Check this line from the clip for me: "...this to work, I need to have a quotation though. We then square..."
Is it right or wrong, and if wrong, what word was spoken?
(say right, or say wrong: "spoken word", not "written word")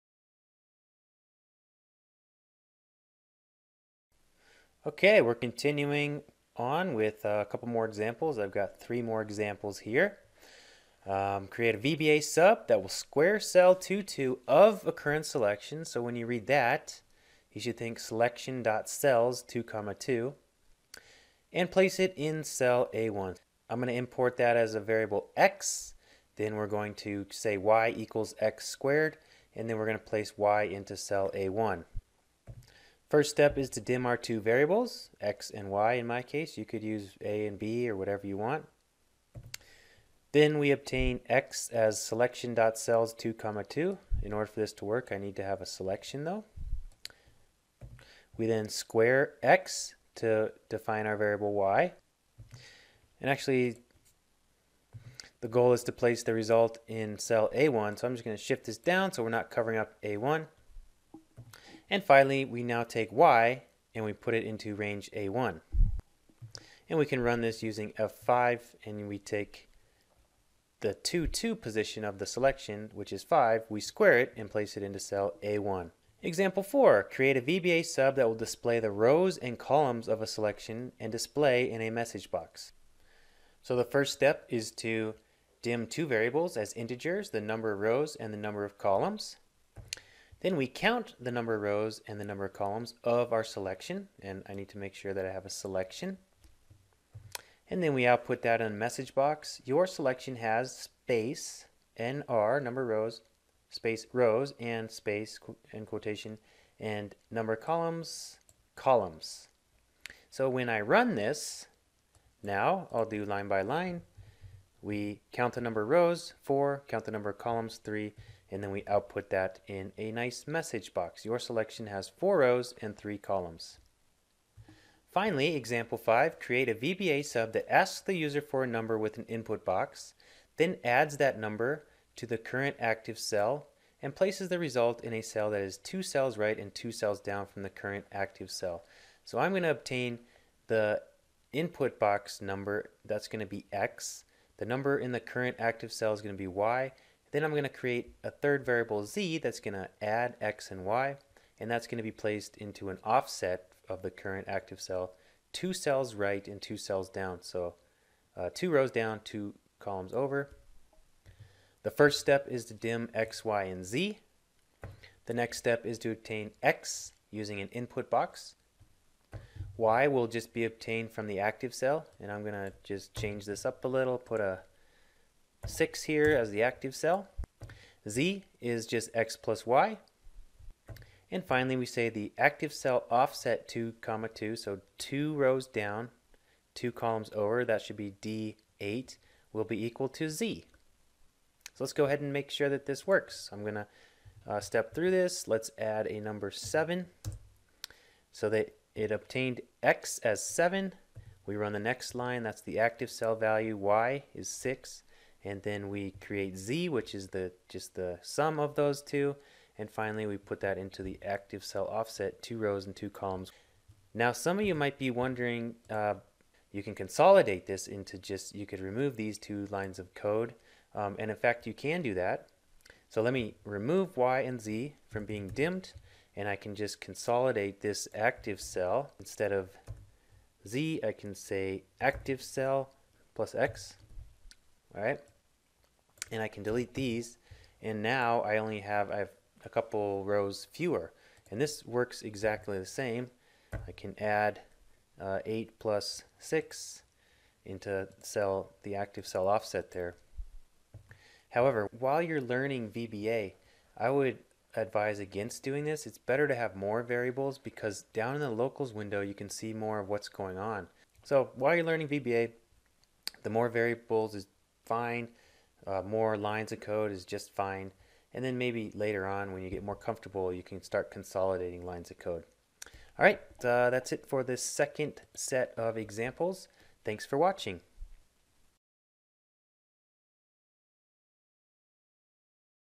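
wrong: "selection", not "quotation".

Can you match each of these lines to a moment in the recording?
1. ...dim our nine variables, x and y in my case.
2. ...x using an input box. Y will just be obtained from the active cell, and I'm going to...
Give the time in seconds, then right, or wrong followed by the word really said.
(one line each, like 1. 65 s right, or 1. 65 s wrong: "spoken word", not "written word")
1. 33 s wrong: "two", not "nine"
2. 166 s right.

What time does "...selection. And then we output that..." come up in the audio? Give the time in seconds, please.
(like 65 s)
95 s.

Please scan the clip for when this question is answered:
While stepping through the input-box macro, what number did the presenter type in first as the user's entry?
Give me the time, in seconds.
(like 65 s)
195 s.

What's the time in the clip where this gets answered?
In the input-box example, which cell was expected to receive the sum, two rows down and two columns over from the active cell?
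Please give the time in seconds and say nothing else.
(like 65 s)
188 s.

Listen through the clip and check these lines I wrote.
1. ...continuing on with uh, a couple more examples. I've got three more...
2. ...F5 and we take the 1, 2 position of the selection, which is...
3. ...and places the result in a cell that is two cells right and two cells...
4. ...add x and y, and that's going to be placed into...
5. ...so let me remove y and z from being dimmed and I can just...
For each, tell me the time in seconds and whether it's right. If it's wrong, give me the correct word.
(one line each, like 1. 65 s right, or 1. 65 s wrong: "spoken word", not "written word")
1. 5 s right
2. 67 s wrong: "2", not "1"
3. 134 s right
4. 150 s right
5. 223 s right.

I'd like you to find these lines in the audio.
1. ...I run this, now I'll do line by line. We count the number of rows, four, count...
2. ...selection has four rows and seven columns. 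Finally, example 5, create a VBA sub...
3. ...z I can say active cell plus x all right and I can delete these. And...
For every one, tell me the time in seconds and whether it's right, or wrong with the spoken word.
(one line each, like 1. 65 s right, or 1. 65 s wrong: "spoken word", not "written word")
1. 110 s right
2. 121 s wrong: "three", not "seven"
3. 230 s right.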